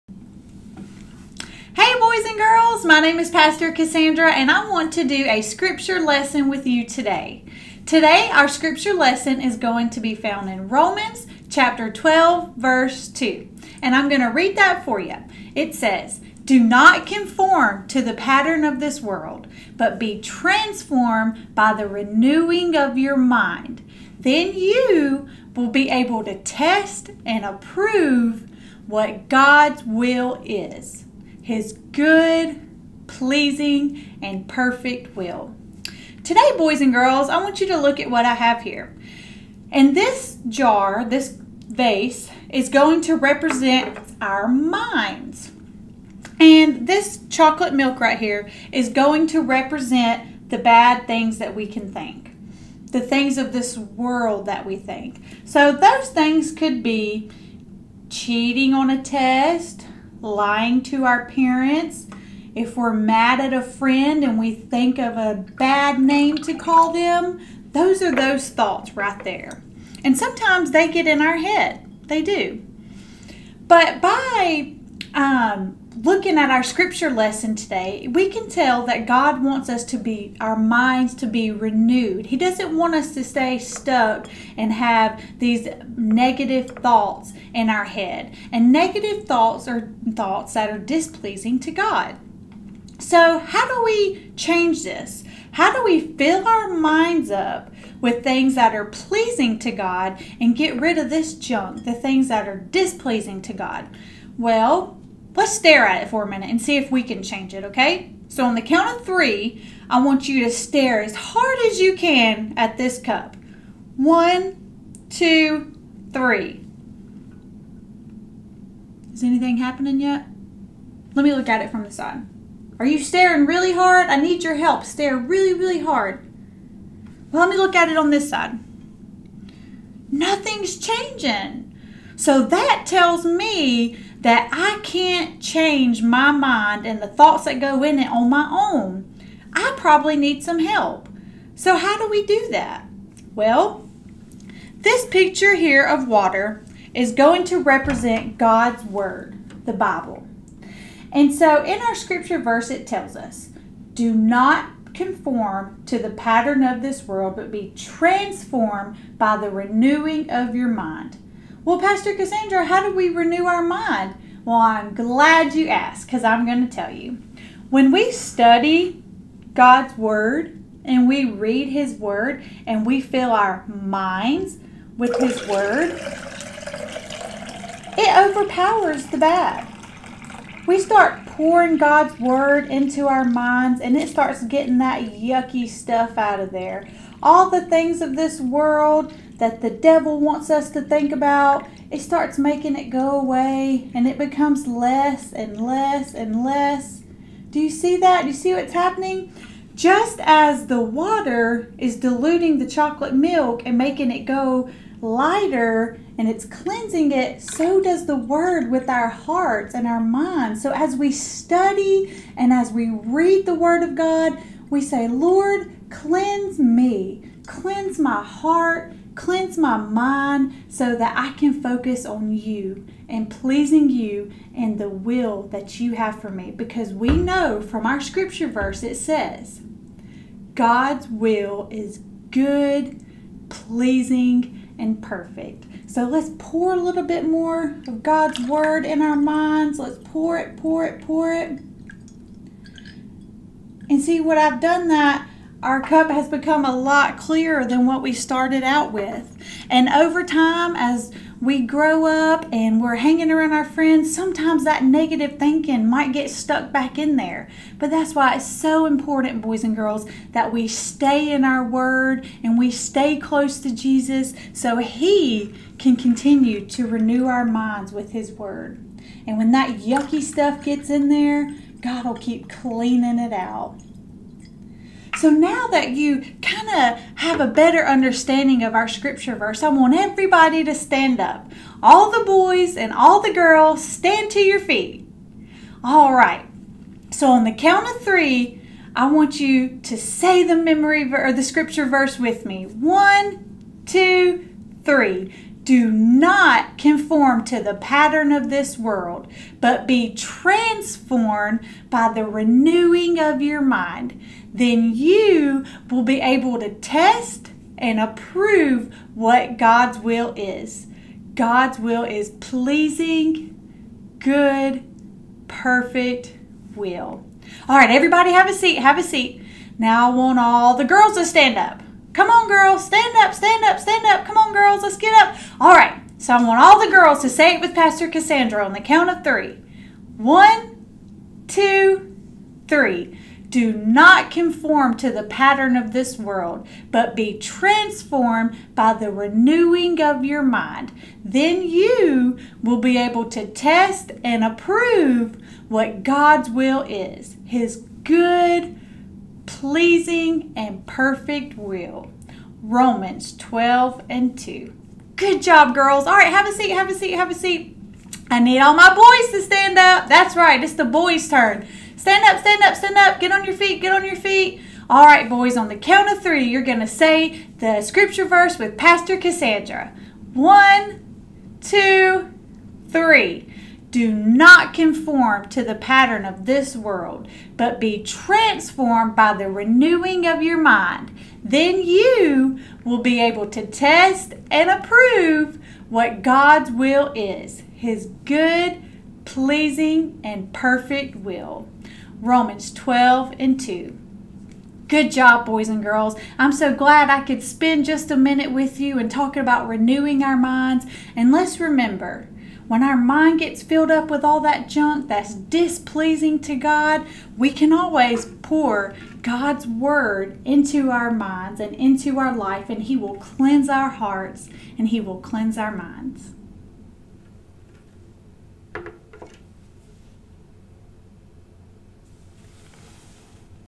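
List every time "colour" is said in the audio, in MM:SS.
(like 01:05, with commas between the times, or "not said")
not said.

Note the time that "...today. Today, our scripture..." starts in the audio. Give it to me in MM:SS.
00:06.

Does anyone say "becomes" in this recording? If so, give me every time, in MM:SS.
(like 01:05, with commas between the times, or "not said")
03:14, 04:06.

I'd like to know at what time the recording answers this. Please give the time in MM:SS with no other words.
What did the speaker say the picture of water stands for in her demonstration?
02:28.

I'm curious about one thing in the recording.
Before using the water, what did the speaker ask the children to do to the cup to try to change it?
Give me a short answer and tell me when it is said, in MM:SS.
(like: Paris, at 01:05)
Stare at it, at 01:50.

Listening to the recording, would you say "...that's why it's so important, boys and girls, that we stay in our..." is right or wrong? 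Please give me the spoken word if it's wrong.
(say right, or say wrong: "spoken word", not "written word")
right.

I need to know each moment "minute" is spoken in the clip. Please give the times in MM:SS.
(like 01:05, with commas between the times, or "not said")
01:46, 06:38.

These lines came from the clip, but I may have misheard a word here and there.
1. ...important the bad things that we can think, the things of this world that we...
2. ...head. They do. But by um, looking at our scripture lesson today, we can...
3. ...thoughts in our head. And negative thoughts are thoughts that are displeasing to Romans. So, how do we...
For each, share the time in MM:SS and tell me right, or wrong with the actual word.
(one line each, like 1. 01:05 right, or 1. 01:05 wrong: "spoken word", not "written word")
1. 00:49 wrong: "represent", not "important"
2. 01:11 right
3. 01:26 wrong: "God", not "Romans".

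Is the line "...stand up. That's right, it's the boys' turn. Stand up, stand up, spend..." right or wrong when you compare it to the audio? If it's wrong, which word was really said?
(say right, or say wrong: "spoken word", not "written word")
wrong: "stand", not "spend".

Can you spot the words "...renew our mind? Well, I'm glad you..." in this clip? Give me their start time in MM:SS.
02:43.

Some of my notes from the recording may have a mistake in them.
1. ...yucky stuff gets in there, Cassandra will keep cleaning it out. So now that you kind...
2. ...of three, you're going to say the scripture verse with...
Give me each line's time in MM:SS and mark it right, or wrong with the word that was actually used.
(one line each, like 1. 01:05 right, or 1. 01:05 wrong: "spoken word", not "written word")
1. 04:29 wrong: "God", not "Cassandra"
2. 06:06 right.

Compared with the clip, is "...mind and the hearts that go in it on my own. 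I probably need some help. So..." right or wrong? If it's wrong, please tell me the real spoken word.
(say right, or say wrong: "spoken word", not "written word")
wrong: "thoughts", not "hearts".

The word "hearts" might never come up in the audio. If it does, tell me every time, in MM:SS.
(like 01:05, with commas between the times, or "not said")
03:29, 03:38, 06:53.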